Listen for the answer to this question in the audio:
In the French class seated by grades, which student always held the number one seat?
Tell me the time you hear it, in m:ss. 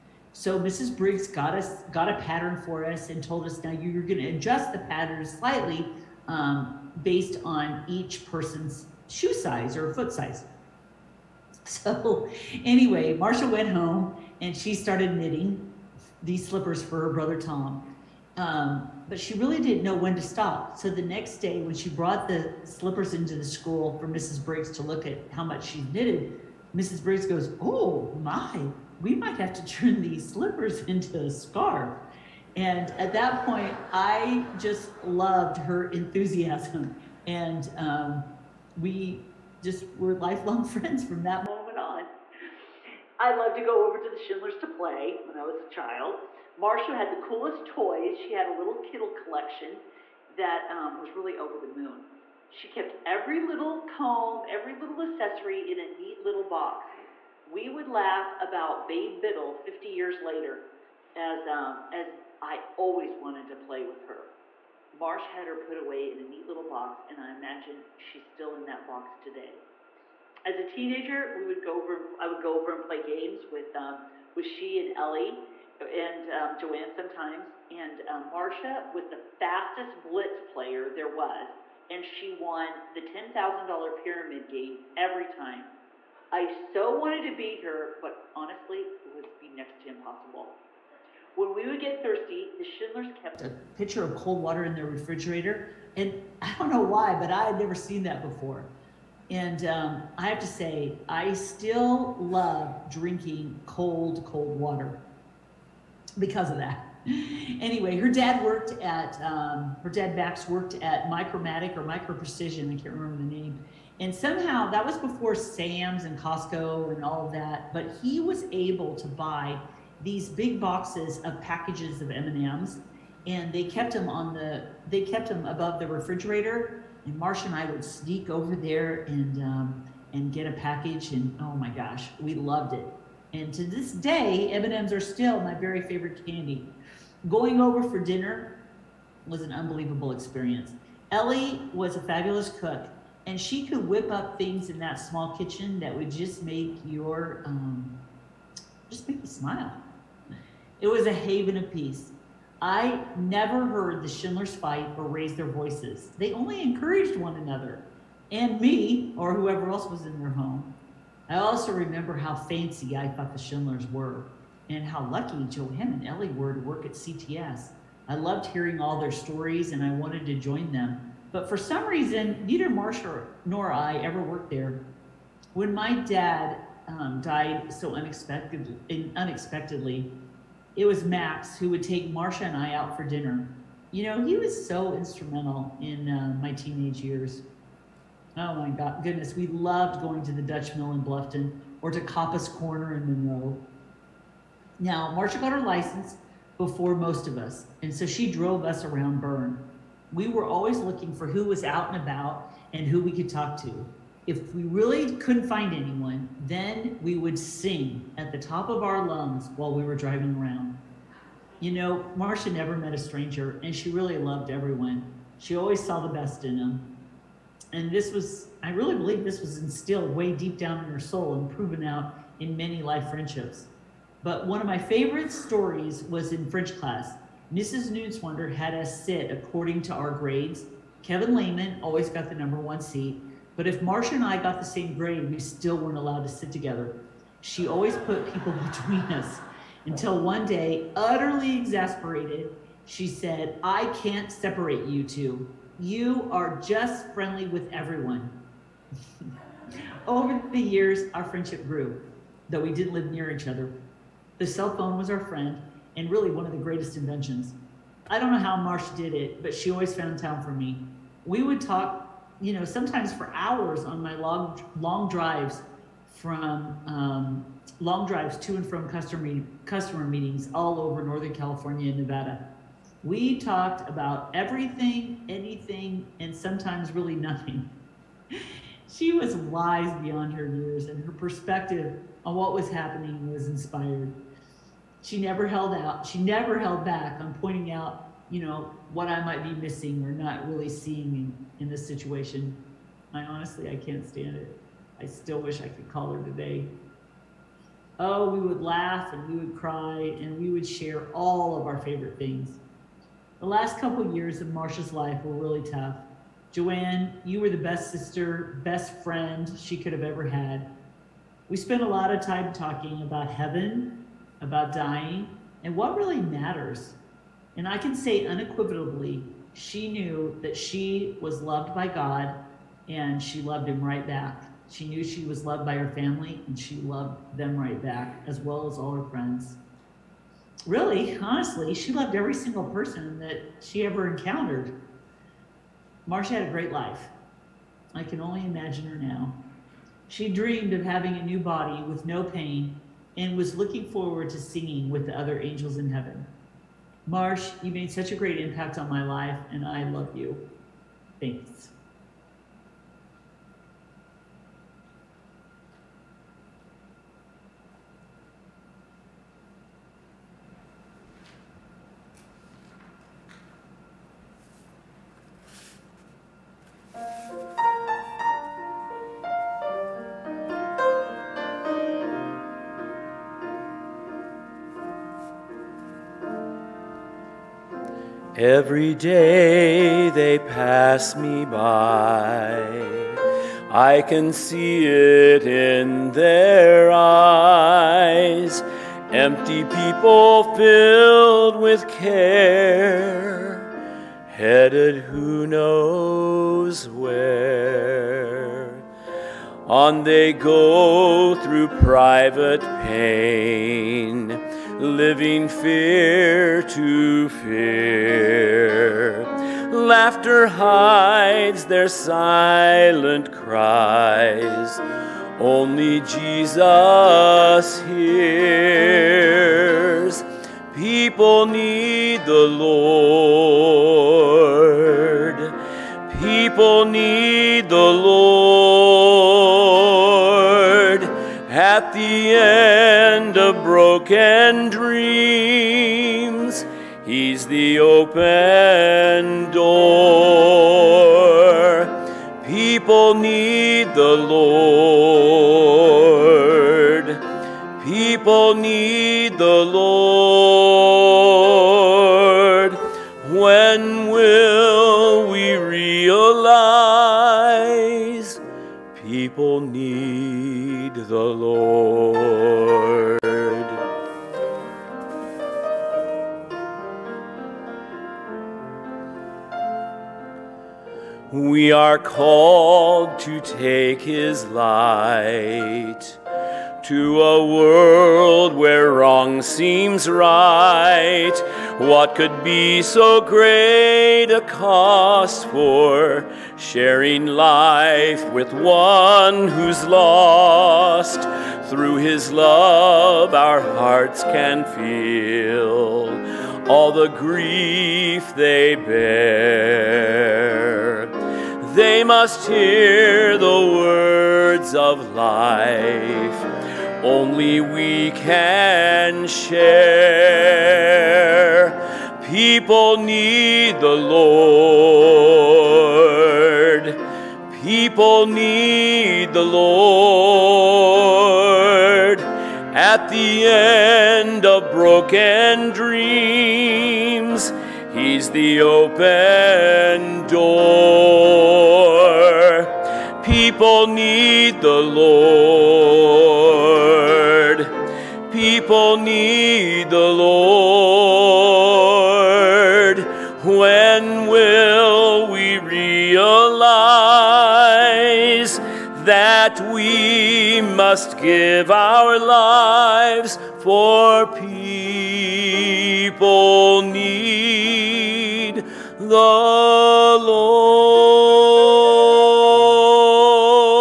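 3:51.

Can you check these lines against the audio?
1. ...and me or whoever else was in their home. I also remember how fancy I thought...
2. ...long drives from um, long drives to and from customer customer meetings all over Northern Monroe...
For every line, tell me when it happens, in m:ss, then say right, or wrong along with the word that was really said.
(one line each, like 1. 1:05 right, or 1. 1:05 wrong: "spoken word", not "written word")
1. 2:38 right
2. 4:24 wrong: "California", not "Monroe".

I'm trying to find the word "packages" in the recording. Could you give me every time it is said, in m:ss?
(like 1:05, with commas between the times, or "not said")
2:01, 2:10.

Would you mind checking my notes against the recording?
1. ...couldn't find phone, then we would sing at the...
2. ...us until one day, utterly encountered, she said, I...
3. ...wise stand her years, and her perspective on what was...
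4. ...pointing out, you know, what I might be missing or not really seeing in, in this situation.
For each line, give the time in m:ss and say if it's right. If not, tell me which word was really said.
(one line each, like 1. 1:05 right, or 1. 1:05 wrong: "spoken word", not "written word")
1. 3:25 wrong: "anyone", not "phone"
2. 3:59 wrong: "exasperated", not "encountered"
3. 4:39 wrong: "beyond", not "stand"
4. 4:47 right.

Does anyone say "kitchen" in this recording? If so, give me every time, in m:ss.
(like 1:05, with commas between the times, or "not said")
2:25.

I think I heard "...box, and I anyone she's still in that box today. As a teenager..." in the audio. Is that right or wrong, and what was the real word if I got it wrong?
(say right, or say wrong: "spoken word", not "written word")
wrong: "imagine", not "anyone".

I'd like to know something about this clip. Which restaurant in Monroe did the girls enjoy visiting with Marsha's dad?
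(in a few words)
Coppess Corner.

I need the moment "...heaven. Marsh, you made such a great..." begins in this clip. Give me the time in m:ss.
5:45.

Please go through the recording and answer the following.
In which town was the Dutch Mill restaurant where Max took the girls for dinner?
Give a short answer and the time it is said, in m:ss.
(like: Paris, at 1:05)
Bluffton, at 3:11.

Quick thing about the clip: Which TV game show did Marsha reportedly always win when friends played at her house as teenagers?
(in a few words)
$10,000 Pyramid.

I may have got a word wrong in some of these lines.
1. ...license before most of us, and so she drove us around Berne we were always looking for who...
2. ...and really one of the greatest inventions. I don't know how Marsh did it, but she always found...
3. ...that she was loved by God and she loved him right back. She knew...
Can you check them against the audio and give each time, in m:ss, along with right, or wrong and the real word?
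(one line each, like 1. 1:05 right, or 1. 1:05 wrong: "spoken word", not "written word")
1. 3:15 right
2. 4:15 right
3. 5:20 right.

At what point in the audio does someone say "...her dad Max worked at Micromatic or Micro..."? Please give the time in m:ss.
1:49.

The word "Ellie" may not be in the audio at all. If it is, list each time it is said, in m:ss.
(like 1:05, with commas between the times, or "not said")
1:14, 2:21, 2:46.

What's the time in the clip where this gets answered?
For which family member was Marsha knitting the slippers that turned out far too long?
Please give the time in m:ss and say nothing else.
0:17.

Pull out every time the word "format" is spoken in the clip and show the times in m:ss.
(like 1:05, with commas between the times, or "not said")
not said.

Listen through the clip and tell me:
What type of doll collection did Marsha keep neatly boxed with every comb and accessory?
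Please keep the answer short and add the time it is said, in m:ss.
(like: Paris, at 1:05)
Liddle Kiddle, at 0:48.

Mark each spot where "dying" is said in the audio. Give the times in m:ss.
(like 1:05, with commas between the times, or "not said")
5:14.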